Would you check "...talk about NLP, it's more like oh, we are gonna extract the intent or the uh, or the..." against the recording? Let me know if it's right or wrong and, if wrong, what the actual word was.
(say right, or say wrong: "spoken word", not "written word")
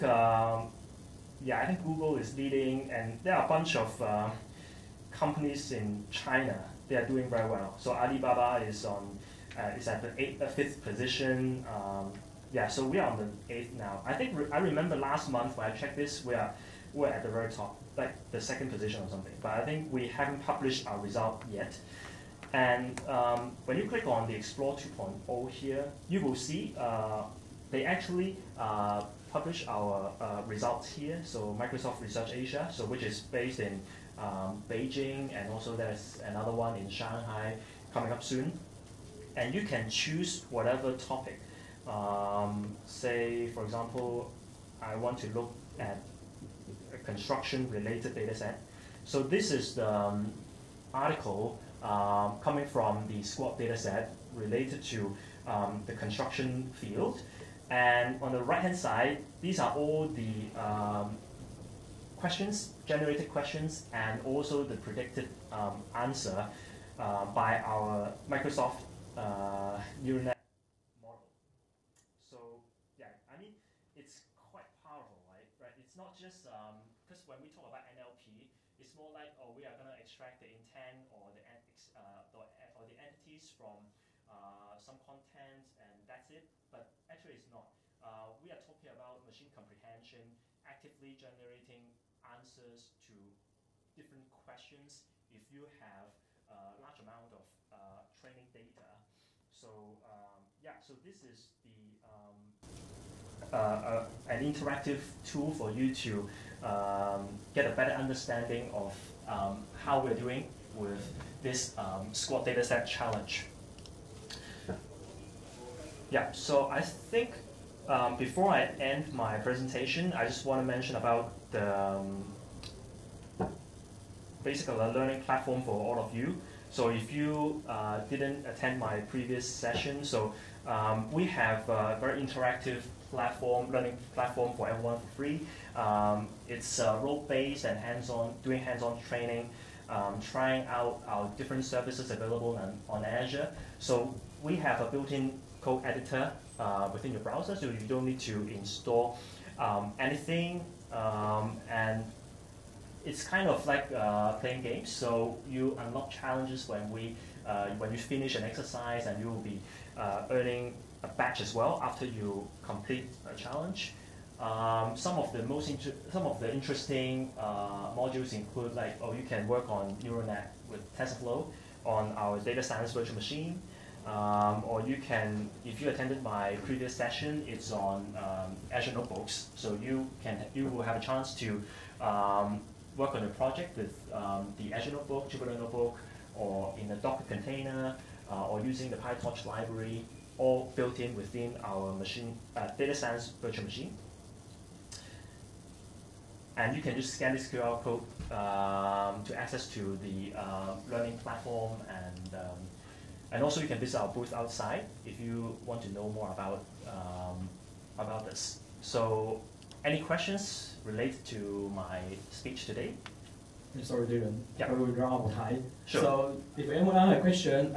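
right.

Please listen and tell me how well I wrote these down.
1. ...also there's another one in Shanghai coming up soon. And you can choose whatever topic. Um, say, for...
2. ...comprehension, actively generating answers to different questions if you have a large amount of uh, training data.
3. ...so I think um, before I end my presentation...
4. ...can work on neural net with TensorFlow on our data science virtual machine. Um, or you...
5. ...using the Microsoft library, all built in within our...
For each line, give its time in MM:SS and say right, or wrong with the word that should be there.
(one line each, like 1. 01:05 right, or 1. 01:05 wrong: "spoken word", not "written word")
1. 00:35 right
2. 01:29 right
3. 01:56 right
4. 02:49 right
5. 03:08 wrong: "PyTorch", not "Microsoft".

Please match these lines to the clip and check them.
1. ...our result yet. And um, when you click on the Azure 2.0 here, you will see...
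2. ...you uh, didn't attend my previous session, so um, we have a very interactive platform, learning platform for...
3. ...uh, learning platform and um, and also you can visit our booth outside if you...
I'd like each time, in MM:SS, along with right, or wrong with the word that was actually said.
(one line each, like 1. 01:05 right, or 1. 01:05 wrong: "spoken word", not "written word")
1. 00:20 wrong: "Explore", not "Azure"
2. 02:07 right
3. 03:20 right.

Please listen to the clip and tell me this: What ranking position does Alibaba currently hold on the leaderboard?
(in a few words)
fifth.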